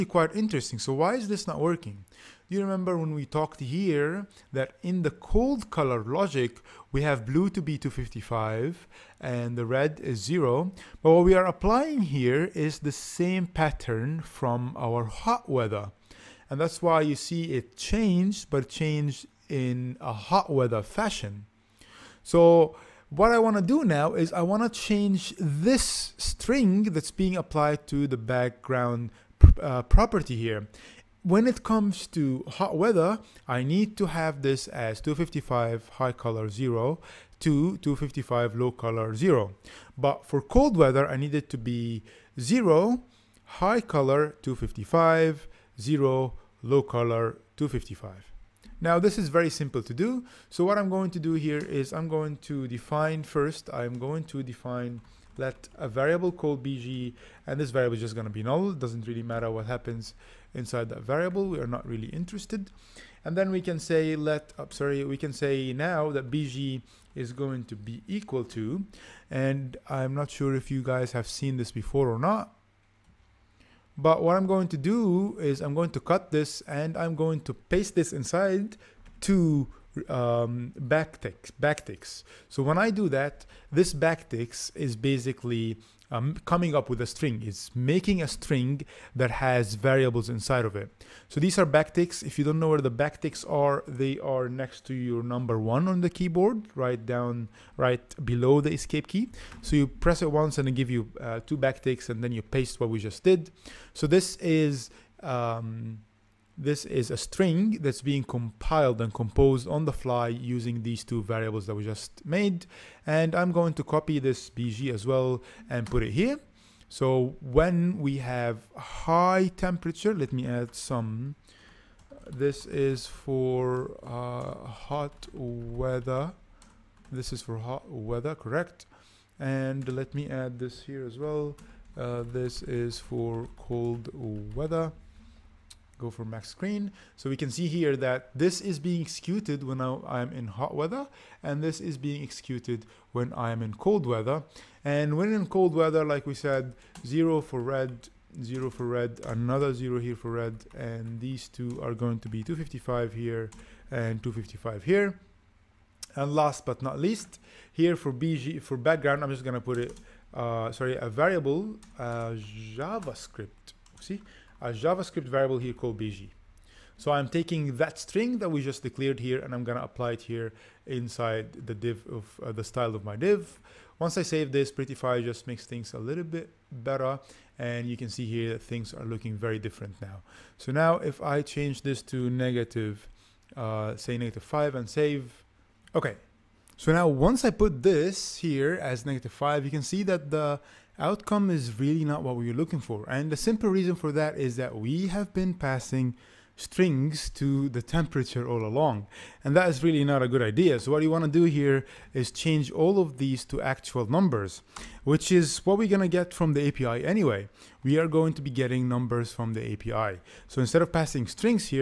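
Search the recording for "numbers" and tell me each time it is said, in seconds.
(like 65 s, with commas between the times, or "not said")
95 s, 204 s, 208 s.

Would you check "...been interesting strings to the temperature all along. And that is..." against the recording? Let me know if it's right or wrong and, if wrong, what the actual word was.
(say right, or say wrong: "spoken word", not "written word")
wrong: "passing", not "interesting".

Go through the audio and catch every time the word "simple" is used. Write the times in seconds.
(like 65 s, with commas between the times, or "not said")
49 s, 193 s.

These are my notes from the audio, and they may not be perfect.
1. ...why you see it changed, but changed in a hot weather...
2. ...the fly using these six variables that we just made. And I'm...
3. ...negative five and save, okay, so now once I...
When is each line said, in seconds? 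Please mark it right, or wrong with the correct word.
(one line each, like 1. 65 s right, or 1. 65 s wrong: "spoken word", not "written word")
1. 16 s right
2. 109 s wrong: "two", not "six"
3. 184 s right.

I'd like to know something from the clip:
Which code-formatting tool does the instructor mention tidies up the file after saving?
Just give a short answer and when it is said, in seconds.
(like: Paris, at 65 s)
Prettyfy, at 174 s.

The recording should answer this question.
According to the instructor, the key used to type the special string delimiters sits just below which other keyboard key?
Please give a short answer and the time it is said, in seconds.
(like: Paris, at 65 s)
escape key, at 98 s.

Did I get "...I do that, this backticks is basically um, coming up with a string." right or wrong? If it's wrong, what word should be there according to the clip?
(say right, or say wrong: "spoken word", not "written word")
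right.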